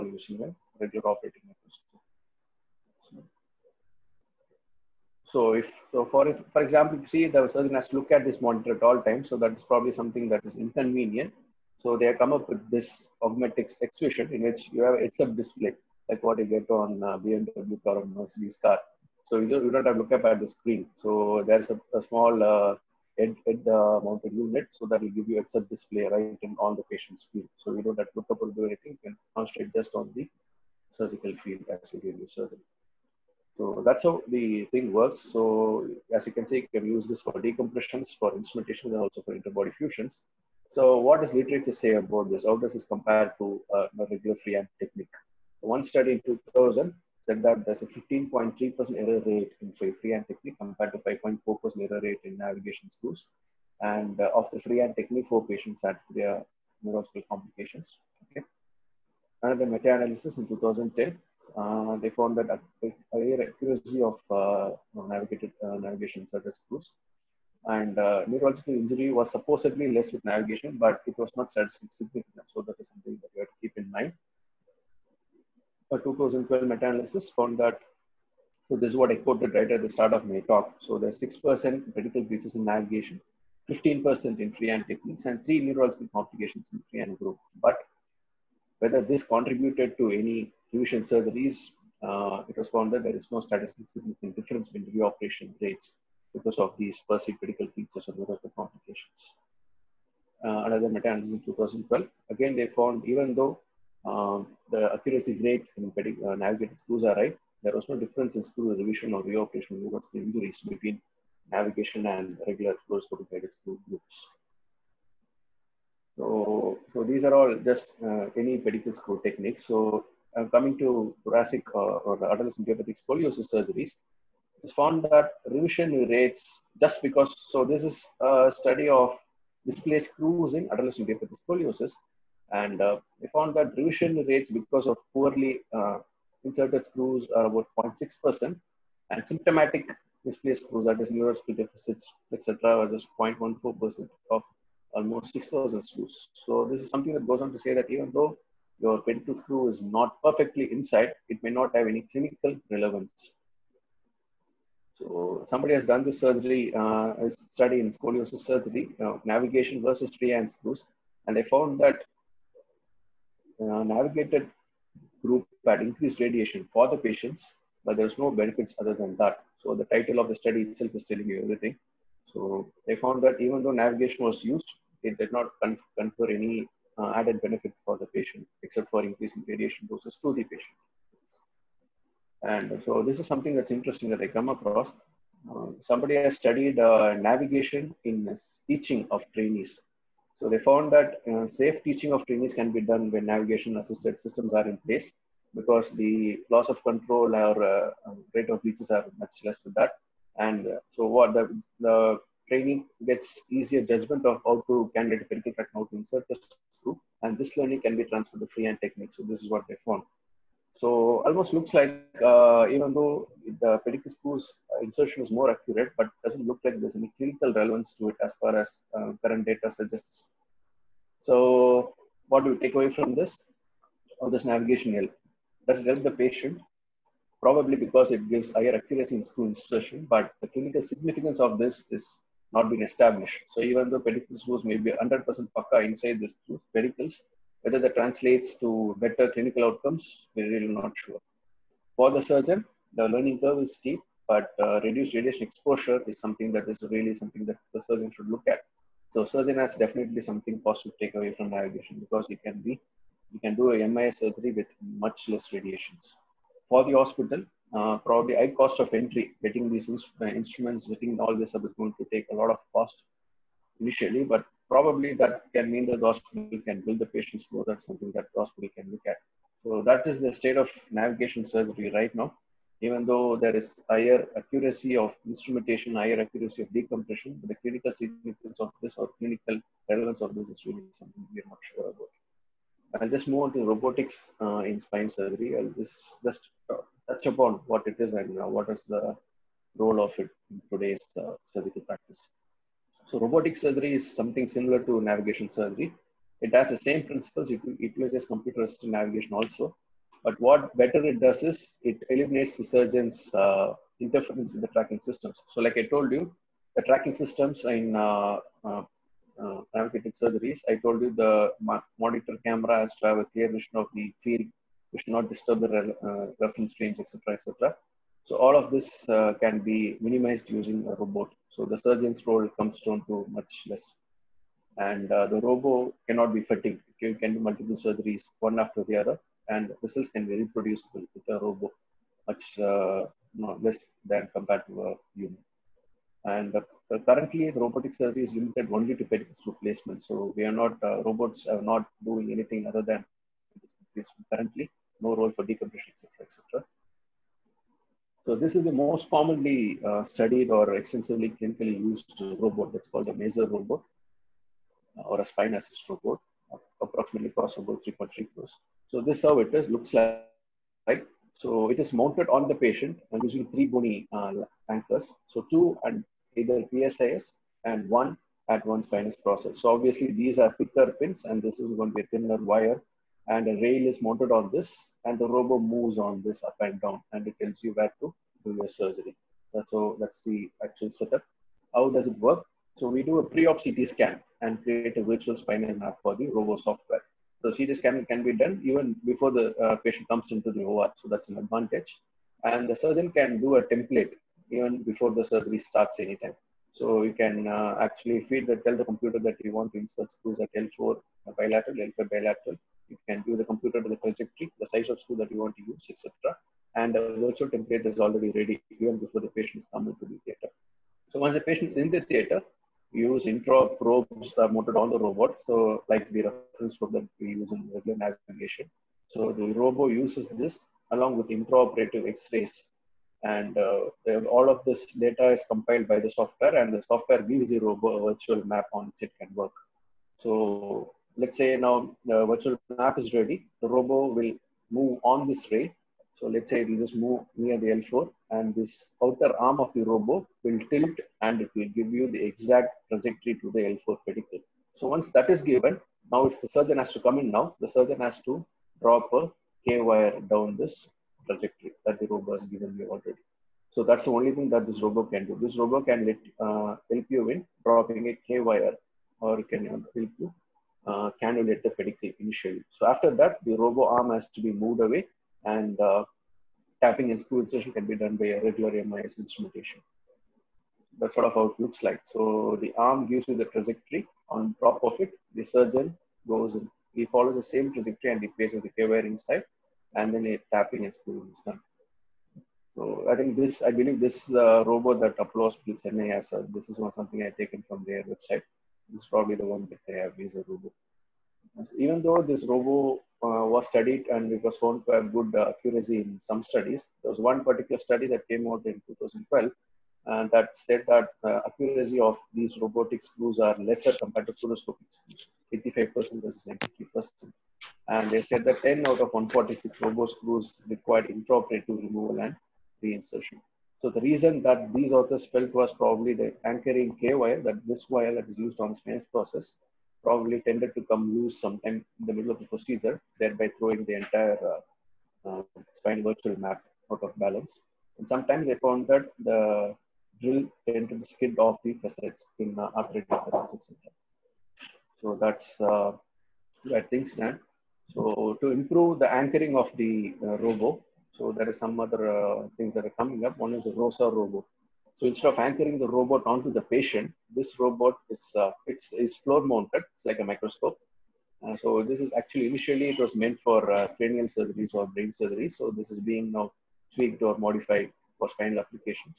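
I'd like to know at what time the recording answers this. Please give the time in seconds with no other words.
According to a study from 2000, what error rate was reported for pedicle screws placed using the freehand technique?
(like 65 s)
47 s.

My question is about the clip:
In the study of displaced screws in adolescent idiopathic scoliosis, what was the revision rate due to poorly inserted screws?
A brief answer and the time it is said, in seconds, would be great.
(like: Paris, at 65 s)
0.6%, at 137 s.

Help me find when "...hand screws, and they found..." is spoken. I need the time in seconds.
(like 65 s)
160 s.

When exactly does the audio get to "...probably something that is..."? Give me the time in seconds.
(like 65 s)
9 s.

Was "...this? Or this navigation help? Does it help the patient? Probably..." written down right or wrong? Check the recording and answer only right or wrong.
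right.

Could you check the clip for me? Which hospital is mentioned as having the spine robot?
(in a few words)
Apollo Hospital Chennai.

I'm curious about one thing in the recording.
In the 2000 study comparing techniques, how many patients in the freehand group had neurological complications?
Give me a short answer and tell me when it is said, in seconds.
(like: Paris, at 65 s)
4, at 55 s.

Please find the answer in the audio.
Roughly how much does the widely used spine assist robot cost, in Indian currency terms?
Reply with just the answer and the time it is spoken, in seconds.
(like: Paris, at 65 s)
3.3 crores, at 357 s.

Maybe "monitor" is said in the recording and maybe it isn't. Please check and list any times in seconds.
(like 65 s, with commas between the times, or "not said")
8 s, 311 s.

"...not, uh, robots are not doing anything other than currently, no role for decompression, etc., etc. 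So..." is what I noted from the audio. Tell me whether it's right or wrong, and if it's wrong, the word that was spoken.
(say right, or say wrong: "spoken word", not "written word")
right.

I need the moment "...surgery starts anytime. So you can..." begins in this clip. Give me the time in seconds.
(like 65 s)
395 s.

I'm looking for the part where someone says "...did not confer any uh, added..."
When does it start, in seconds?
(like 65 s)
175 s.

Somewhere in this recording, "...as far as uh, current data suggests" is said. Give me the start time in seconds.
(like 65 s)
218 s.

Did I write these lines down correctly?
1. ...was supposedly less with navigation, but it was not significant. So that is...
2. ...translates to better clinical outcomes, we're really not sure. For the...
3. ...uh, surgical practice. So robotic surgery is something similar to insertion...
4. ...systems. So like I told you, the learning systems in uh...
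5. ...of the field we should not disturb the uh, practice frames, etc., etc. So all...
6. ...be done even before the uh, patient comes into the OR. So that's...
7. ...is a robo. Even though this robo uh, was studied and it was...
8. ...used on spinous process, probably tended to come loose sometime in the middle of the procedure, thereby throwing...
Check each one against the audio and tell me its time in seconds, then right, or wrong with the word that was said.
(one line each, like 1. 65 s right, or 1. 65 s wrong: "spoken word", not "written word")
1. 69 s right
2. 237 s right
3. 291 s wrong: "navigation", not "insertion"
4. 305 s wrong: "tracking", not "learning"
5. 313 s wrong: "reference", not "practice"
6. 388 s right
7. 490 s right
8. 518 s right.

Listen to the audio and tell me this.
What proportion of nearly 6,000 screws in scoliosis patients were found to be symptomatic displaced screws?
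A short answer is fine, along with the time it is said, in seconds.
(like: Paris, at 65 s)
0.14%, at 143 s.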